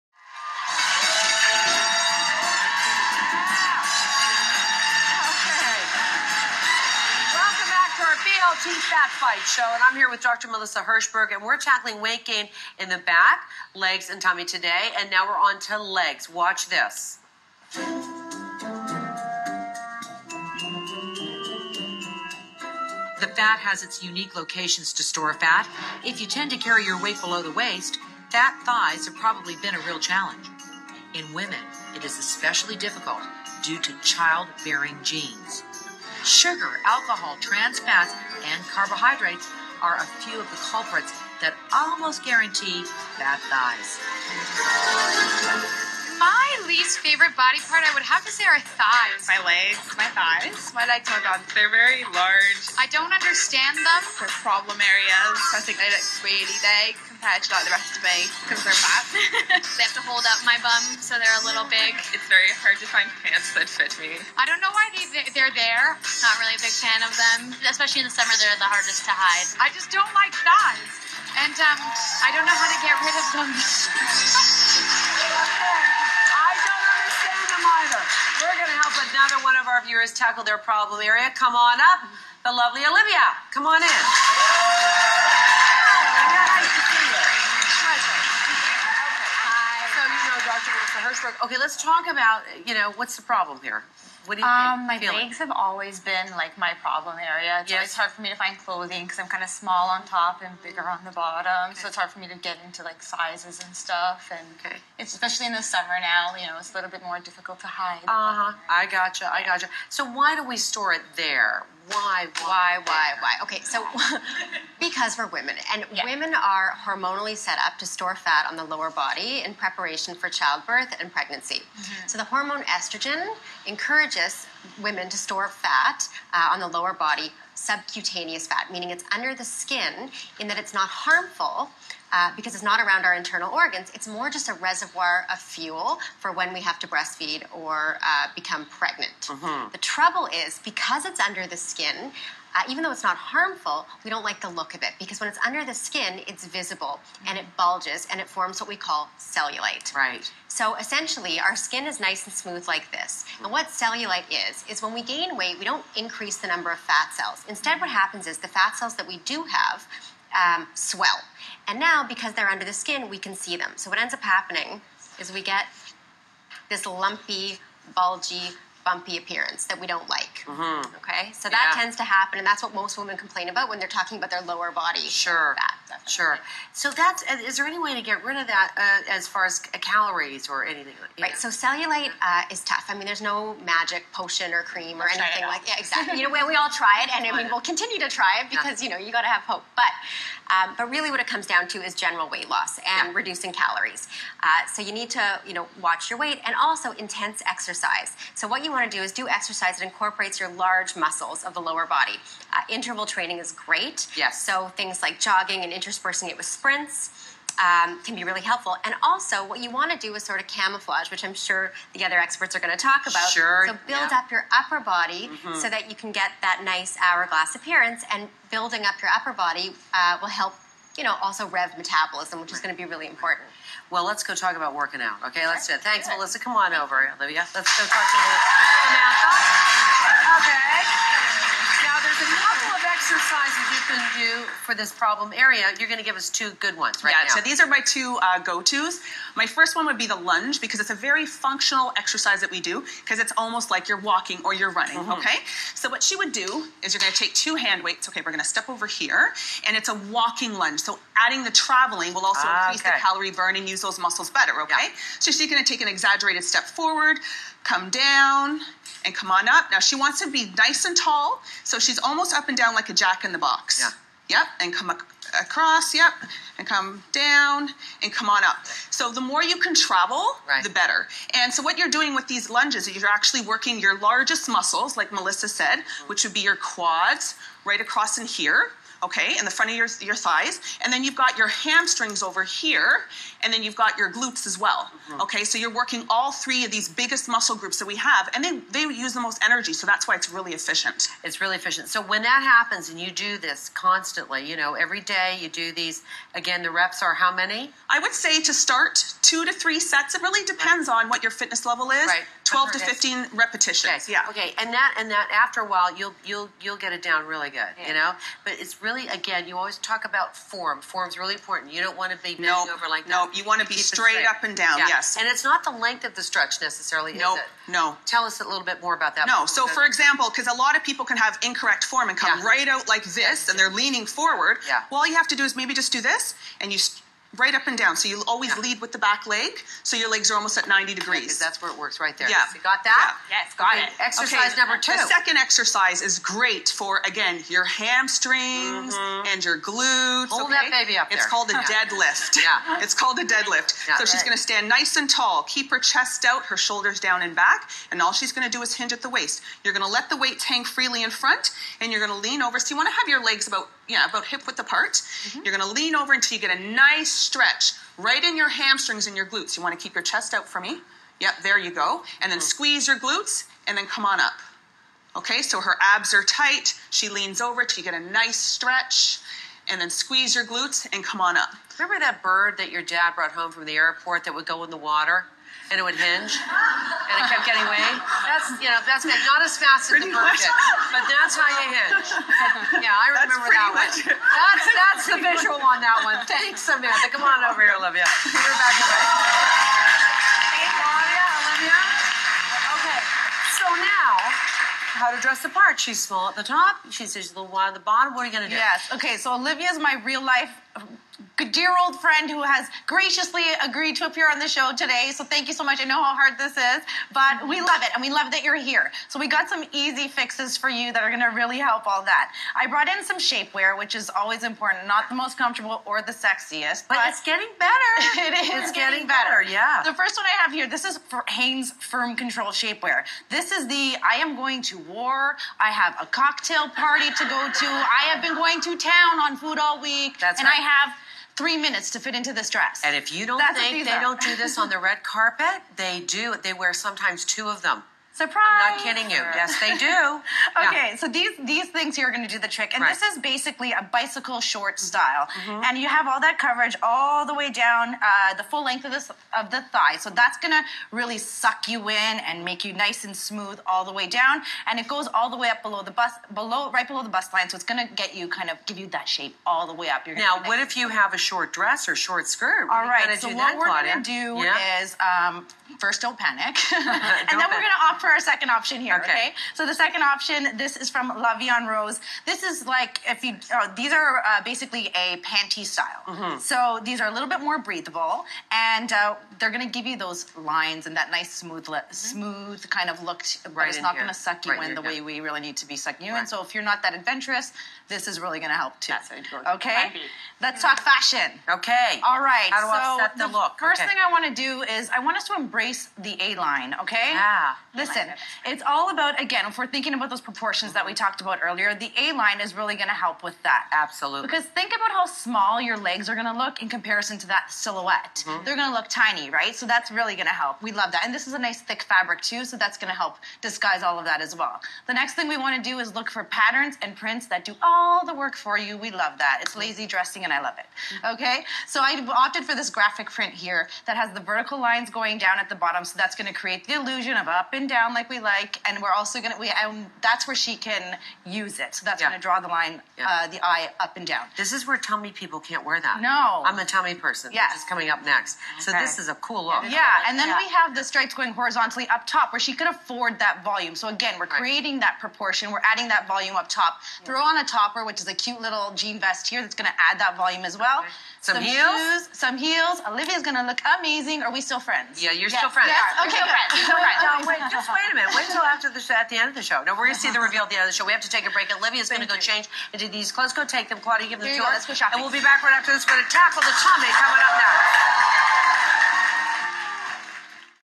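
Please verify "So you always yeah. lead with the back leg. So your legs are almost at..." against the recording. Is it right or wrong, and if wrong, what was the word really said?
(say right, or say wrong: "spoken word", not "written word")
right.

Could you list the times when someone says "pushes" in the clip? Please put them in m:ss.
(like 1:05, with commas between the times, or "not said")
not said.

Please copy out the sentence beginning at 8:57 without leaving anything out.
Yes, this is coming up next.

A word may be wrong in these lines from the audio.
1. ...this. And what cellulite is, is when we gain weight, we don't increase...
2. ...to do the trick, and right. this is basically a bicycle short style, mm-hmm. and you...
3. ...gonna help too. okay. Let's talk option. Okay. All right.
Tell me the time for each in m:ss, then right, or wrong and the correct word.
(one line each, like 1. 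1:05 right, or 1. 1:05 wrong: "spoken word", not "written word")
1. 2:32 right
2. 7:22 right
3. 8:08 wrong: "fashion", not "option".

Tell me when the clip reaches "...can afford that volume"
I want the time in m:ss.
9:02.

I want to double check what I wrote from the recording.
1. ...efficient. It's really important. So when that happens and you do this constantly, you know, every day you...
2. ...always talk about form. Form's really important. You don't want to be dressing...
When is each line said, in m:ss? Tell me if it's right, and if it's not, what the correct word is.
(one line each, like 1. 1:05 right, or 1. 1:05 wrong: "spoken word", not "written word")
1. 4:50 wrong: "efficient", not "important"
2. 5:09 wrong: "bending", not "dressing".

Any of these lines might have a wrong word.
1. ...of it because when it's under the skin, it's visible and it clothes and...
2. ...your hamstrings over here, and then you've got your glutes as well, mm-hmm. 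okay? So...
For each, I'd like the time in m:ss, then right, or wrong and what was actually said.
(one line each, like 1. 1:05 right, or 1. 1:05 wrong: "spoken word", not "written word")
1. 2:24 wrong: "bulges", not "clothes"
2. 4:41 right.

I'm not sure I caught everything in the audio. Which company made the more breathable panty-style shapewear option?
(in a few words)
La Vie en Rose.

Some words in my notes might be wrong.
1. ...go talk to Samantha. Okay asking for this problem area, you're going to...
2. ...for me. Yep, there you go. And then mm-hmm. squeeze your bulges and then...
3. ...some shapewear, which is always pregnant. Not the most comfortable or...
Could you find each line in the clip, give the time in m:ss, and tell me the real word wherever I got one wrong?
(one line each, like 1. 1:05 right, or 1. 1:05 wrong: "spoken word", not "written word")
1. 3:47 right
2. 6:00 wrong: "glutes", not "bulges"
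3. 6:53 wrong: "important", not "pregnant".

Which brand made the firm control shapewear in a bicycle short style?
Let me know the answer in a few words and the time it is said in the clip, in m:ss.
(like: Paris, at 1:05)
Hanes, at 7:01.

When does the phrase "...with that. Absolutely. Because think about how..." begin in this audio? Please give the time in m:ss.
8:23.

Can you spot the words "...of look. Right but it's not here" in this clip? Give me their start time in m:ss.
8:02.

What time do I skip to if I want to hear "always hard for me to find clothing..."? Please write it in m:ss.
1:37.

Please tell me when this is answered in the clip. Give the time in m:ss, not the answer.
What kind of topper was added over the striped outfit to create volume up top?
9:08.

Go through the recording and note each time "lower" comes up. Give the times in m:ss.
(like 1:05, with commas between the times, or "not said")
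1:58, 2:06, 2:54, 3:21.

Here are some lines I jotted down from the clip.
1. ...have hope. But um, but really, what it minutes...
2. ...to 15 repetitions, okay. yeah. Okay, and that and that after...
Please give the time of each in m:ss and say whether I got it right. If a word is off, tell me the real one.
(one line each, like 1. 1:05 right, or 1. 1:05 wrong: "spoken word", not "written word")
1. 3:09 wrong: "comes", not "minutes"
2. 5:02 right.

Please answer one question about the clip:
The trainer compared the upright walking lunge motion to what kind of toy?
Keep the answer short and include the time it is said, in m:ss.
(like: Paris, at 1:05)
a jack in the box, at 4:22.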